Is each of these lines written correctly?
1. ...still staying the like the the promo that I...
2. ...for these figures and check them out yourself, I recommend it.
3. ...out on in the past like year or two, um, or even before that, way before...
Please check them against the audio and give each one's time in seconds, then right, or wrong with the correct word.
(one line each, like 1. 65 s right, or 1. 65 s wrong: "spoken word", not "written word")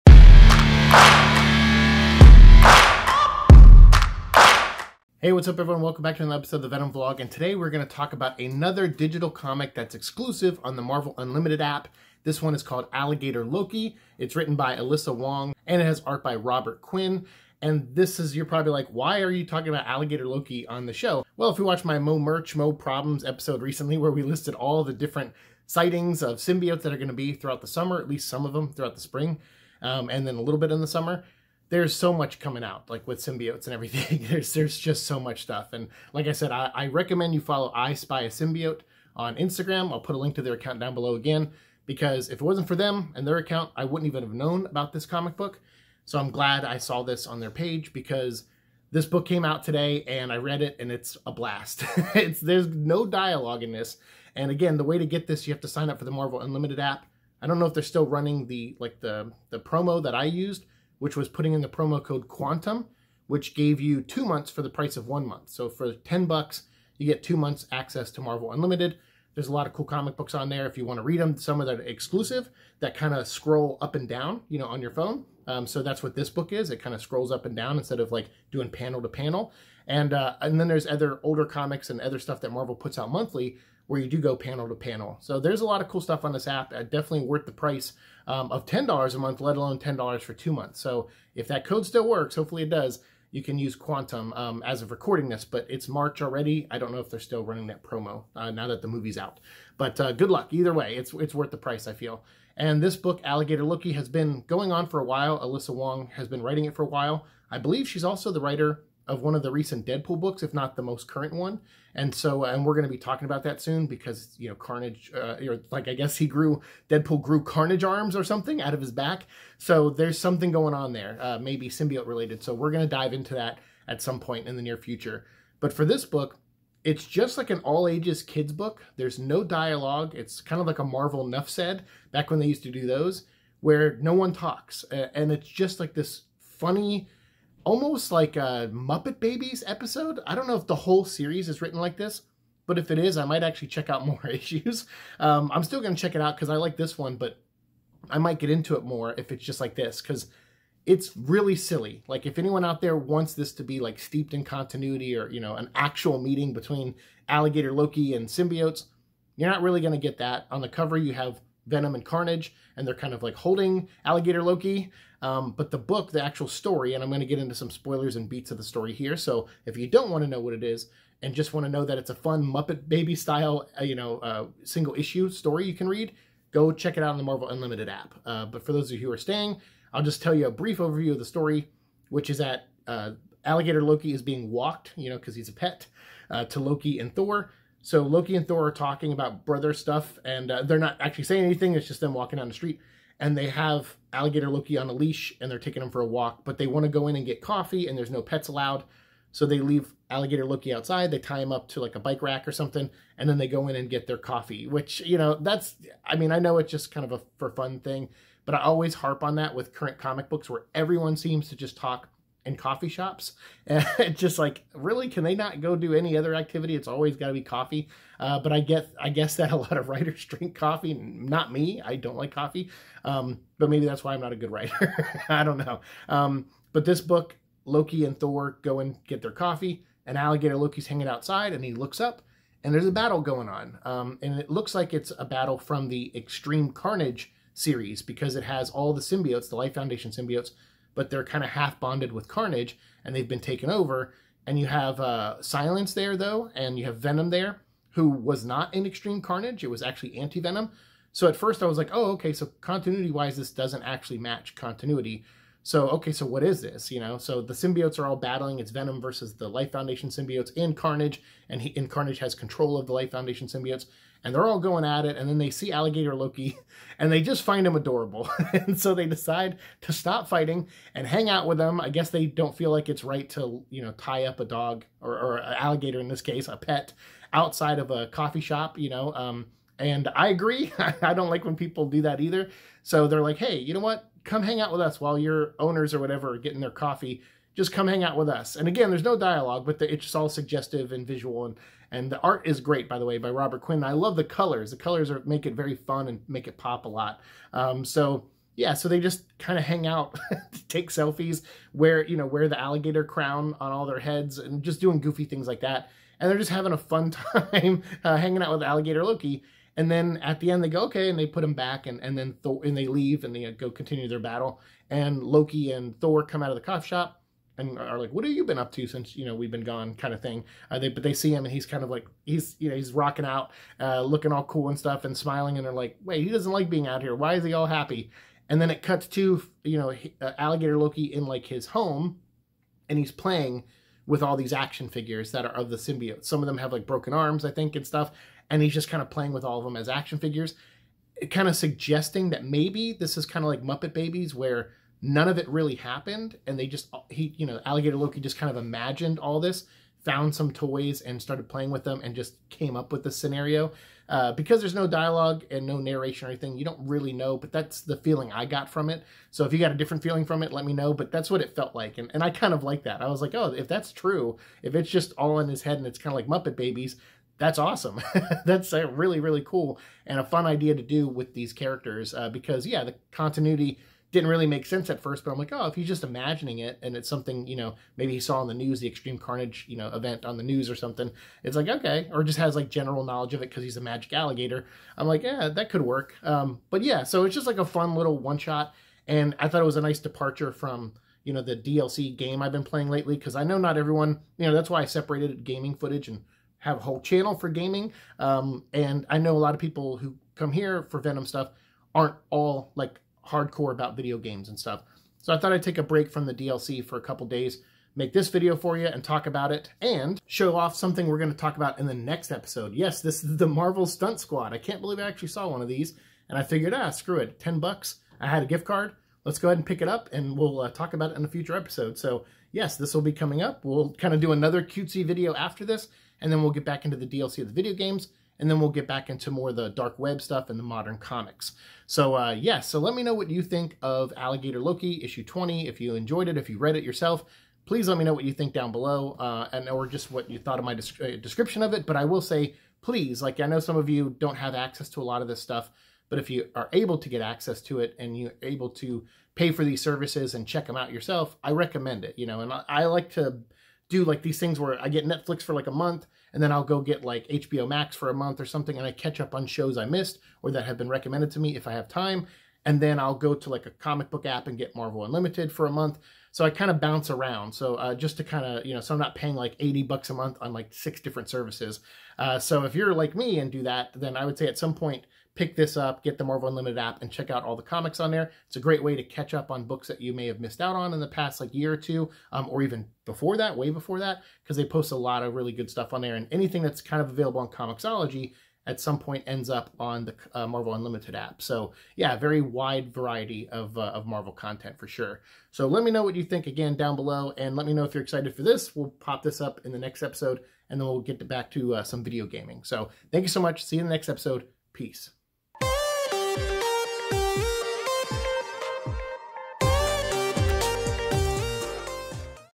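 1. 57 s wrong: "running", not "staying"
2. 449 s wrong: "services", not "figures"
3. 480 s right.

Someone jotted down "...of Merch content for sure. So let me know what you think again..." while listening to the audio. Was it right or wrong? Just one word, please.
wrong.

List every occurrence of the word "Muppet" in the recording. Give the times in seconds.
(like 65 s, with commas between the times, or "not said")
138 s, 172 s, 343 s, 366 s.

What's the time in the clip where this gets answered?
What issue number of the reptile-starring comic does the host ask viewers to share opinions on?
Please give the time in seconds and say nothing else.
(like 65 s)
435 s.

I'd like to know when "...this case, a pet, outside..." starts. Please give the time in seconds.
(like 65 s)
276 s.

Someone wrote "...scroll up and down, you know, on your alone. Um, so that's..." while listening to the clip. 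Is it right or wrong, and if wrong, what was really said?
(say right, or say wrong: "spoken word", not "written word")
wrong: "phone", not "alone".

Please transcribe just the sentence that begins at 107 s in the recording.
I believe she's also the writer of one of the recent Deadpool books, if not the most current one.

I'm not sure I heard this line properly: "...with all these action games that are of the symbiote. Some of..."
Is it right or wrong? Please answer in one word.
wrong.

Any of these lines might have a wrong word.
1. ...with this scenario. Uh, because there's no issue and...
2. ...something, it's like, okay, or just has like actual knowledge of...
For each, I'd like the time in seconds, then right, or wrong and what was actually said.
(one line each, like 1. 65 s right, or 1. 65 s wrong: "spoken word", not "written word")
1. 352 s wrong: "dialogue", not "issue"
2. 380 s wrong: "general", not "actual".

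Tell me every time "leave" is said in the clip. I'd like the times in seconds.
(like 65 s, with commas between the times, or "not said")
199 s, 312 s.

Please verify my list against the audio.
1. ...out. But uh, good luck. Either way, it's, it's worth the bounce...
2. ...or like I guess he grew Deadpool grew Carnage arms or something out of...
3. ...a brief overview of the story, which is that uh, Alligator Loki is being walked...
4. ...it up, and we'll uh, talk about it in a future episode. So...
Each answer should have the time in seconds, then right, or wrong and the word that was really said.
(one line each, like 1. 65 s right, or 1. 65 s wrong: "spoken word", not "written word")
1. 99 s wrong: "price", not "bounce"
2. 115 s right
3. 180 s right
4. 419 s right.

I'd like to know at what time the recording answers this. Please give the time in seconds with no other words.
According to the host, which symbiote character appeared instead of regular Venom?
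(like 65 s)
250 s.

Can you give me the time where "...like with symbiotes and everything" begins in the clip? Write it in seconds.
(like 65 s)
32 s.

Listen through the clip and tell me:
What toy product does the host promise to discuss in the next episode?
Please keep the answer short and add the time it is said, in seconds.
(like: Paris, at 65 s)
Marvel Stunt Squad, at 413 s.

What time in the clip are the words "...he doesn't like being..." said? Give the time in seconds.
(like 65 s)
326 s.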